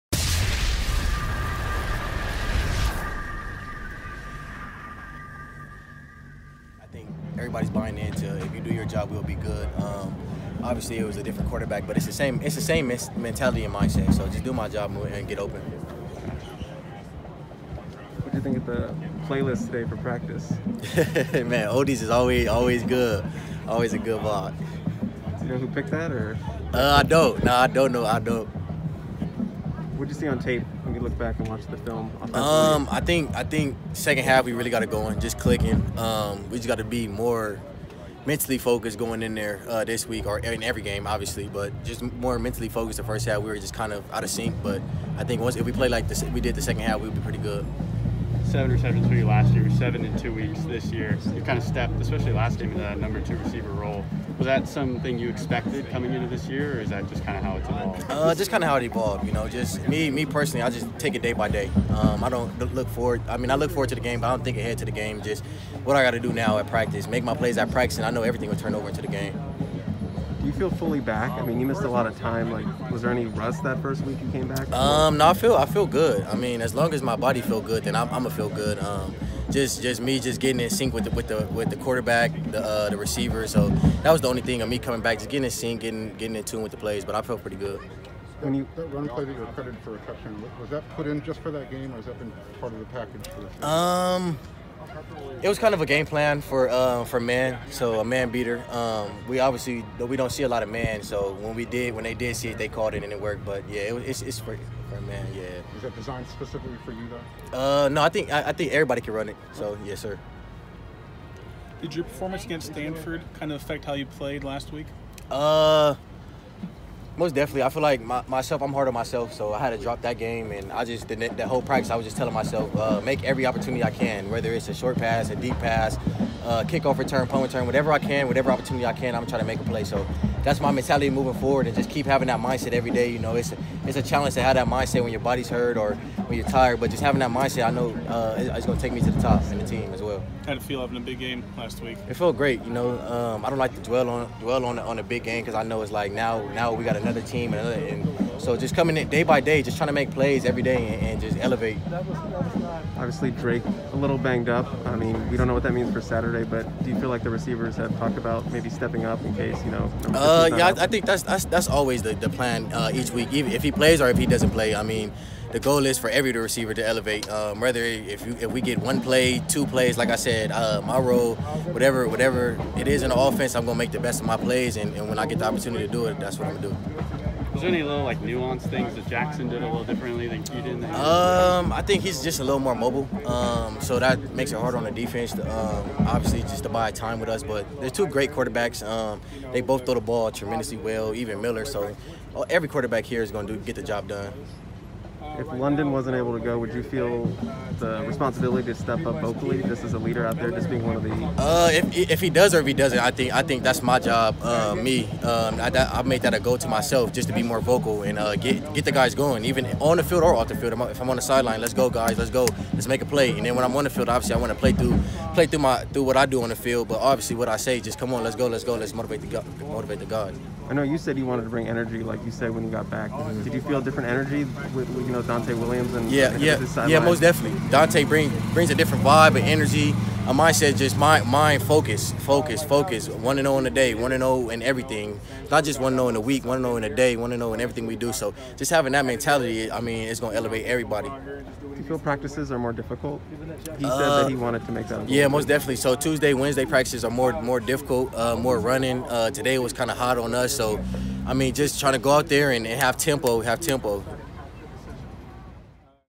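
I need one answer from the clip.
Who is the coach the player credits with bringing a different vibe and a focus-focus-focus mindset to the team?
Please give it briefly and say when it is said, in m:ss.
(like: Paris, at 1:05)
Donte Williams, at 3:45.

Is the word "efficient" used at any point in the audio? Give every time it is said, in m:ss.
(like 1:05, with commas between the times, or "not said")
not said.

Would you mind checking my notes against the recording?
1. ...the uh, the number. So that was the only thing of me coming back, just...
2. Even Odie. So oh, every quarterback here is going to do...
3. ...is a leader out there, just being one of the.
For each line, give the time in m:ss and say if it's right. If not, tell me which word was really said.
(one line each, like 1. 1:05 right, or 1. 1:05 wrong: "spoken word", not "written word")
1. 1:22 wrong: "receiver", not "number"
2. 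3:11 wrong: "Miller", not "Odie"
3. 3:19 right.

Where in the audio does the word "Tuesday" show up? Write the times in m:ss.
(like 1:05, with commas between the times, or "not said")
4:05.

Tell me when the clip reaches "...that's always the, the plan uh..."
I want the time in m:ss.
2:41.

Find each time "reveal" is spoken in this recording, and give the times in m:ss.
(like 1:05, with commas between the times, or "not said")
not said.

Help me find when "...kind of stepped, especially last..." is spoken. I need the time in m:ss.
0:51.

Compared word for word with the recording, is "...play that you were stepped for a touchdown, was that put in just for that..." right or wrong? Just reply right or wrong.
wrong.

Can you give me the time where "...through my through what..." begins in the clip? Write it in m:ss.
3:35.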